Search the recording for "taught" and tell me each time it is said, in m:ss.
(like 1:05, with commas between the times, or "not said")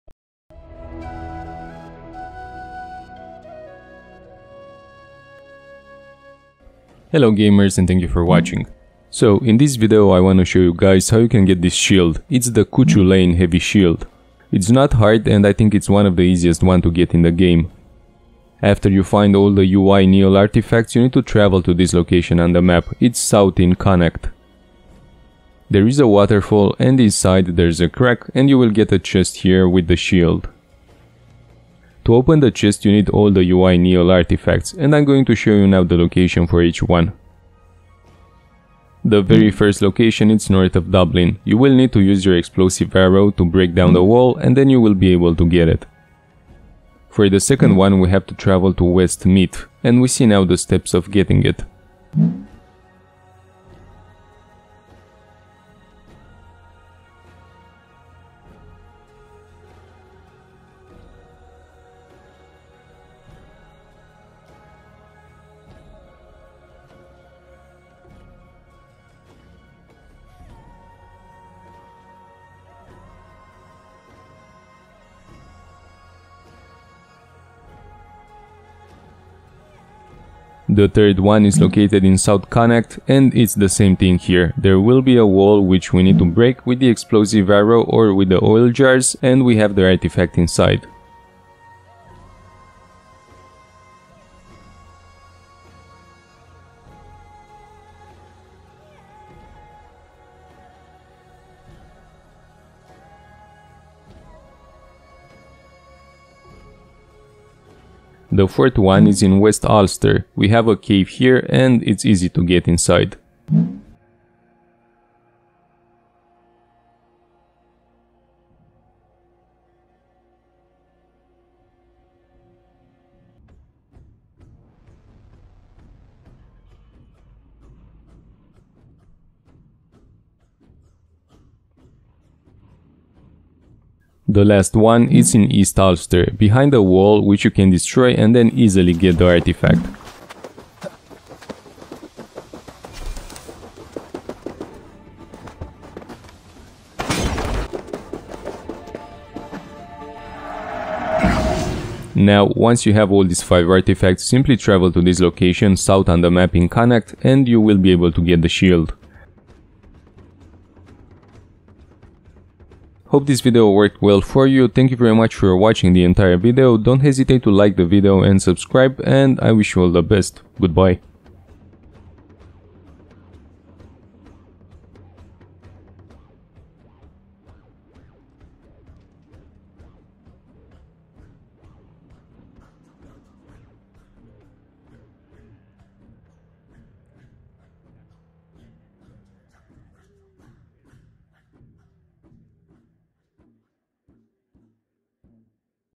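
not said.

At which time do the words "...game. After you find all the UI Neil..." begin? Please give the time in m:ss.
0:17.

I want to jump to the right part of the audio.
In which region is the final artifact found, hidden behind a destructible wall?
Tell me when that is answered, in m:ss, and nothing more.
2:15.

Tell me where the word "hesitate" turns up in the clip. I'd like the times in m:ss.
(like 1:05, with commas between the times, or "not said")
2:47.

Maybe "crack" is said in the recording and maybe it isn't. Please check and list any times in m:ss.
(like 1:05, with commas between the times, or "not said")
0:27.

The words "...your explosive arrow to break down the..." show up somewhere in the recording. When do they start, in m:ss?
0:42.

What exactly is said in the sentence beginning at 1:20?
The third one is located in South Connacht and it's the same thing here.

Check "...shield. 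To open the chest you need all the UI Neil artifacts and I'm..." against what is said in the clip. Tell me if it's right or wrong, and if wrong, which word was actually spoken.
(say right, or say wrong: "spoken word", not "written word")
right.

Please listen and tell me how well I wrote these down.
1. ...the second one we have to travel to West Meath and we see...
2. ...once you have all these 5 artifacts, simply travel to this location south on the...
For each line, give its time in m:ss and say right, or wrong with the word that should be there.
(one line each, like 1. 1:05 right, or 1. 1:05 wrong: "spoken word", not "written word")
1. 0:47 right
2. 2:32 right.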